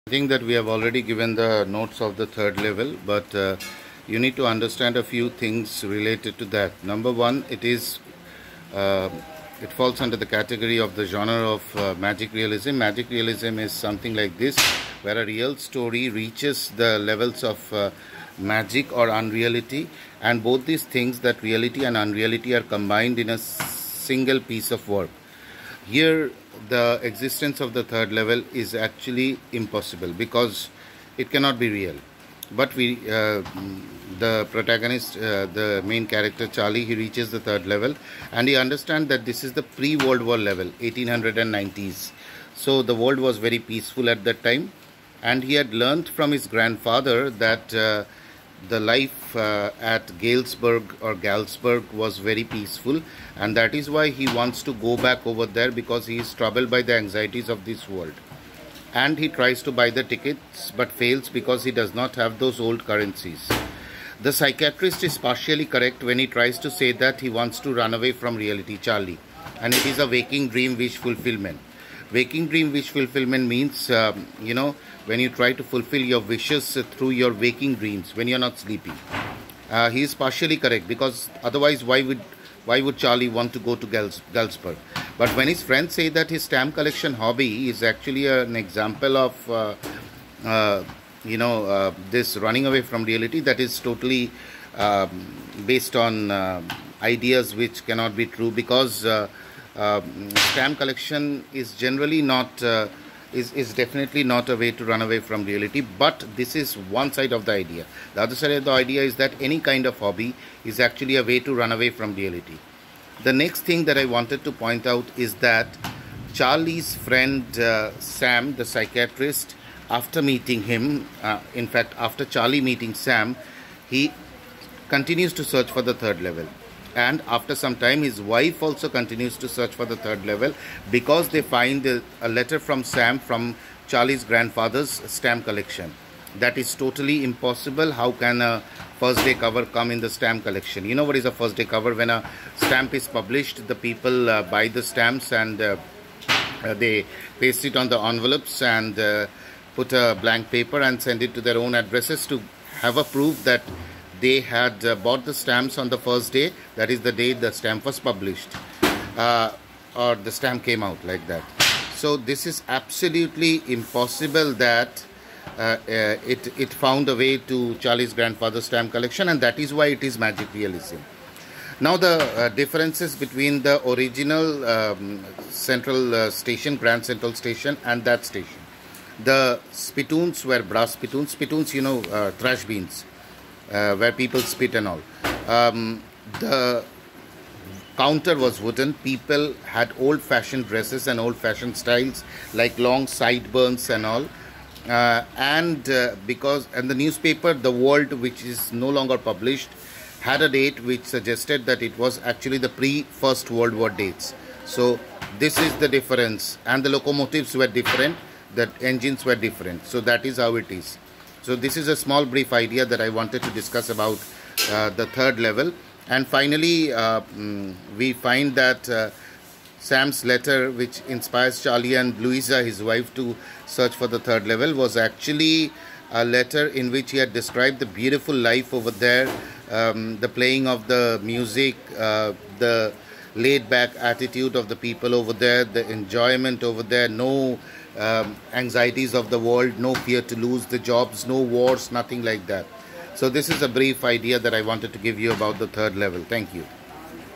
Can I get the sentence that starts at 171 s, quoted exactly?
Now the uh, differences between the original um, central uh, station, Grand Central Station, and that station.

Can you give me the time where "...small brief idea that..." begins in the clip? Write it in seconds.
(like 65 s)
211 s.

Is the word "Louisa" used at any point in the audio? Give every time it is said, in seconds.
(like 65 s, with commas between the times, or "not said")
222 s.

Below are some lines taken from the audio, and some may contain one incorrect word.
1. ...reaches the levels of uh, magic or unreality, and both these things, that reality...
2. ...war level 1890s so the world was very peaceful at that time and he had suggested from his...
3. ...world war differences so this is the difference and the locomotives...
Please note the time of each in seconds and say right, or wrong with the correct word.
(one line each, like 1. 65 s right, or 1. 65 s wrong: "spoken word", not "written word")
1. 16 s right
2. 40 s wrong: "learned", not "suggested"
3. 203 s wrong: "dates", not "differences".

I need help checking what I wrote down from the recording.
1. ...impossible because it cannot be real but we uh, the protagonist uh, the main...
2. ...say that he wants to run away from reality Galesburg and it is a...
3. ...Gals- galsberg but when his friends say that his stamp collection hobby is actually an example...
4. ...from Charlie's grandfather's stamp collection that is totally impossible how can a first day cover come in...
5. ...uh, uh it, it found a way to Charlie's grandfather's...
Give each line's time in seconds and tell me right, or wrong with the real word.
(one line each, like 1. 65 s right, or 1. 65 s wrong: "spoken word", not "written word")
1. 29 s right
2. 66 s wrong: "Charlie", not "Galesburg"
3. 83 s right
4. 133 s right
5. 165 s right.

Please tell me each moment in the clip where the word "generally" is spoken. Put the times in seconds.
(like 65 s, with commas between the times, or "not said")
101 s.